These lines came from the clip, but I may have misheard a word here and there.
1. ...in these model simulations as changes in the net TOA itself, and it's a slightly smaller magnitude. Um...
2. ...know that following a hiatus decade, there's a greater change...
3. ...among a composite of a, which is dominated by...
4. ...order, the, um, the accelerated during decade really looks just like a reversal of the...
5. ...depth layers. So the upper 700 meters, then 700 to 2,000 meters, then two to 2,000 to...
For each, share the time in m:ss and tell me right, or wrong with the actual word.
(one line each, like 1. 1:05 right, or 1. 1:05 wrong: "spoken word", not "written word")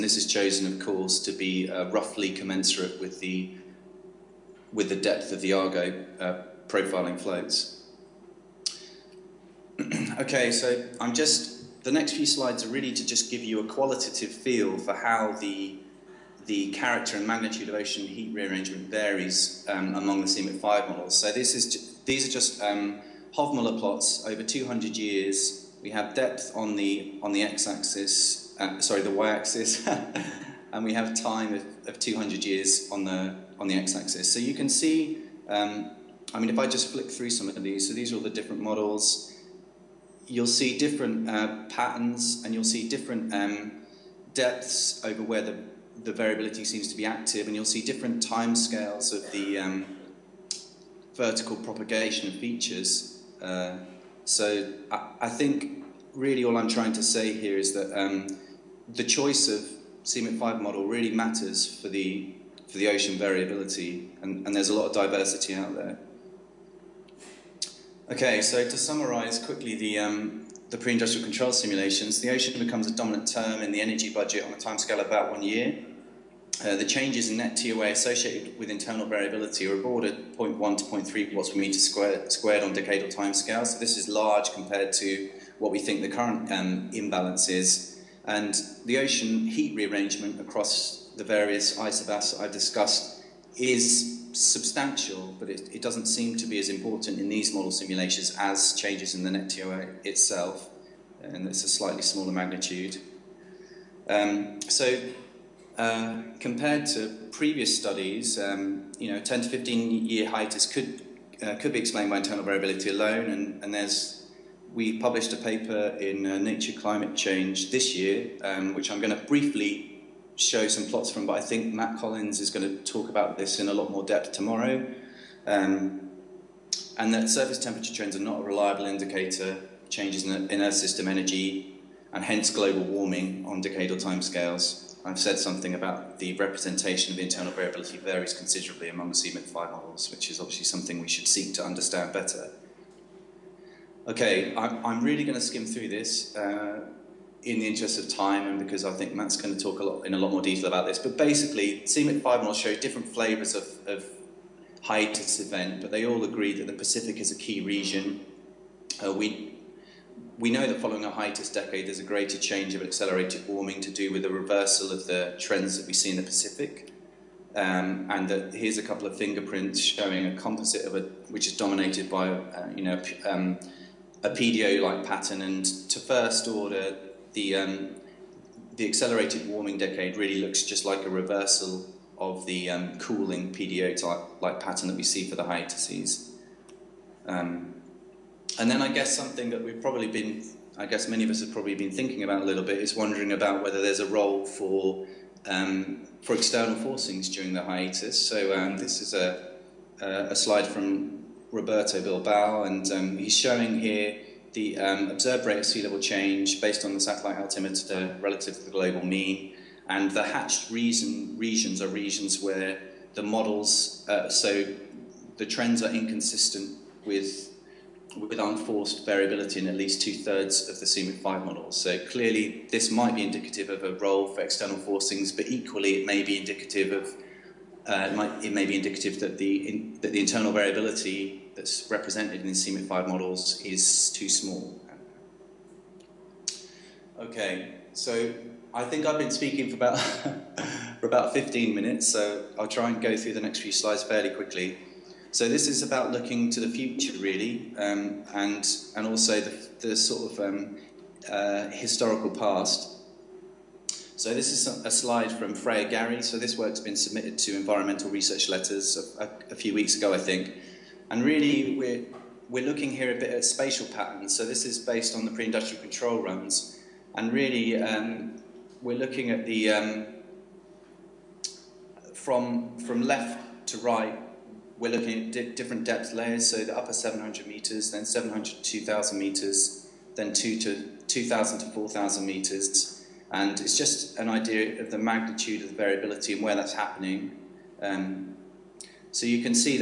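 1. 1:37 right
2. 2:40 right
3. 2:49 wrong: "showing", not "among"
4. 2:56 wrong: "warming", not "during"
5. 4:35 right.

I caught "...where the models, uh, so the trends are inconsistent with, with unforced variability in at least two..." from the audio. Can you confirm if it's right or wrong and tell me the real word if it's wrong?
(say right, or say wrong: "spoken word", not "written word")
right.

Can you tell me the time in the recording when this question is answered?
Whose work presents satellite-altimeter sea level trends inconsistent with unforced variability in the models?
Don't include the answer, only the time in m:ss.
3:21.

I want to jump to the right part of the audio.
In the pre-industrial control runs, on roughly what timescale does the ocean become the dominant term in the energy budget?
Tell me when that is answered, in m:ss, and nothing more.
1:15.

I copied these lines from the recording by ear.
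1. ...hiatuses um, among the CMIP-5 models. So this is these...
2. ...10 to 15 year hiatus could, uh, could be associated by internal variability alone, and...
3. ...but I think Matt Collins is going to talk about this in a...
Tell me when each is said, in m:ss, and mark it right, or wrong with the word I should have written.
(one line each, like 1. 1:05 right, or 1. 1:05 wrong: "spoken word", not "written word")
1. 0:18 wrong: "varies", not "hiatuses"
2. 1:49 wrong: "explained", not "associated"
3. 2:01 right.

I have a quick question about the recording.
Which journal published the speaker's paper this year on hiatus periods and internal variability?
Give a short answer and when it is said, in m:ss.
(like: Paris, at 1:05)
Nature Climate Change, at 1:56.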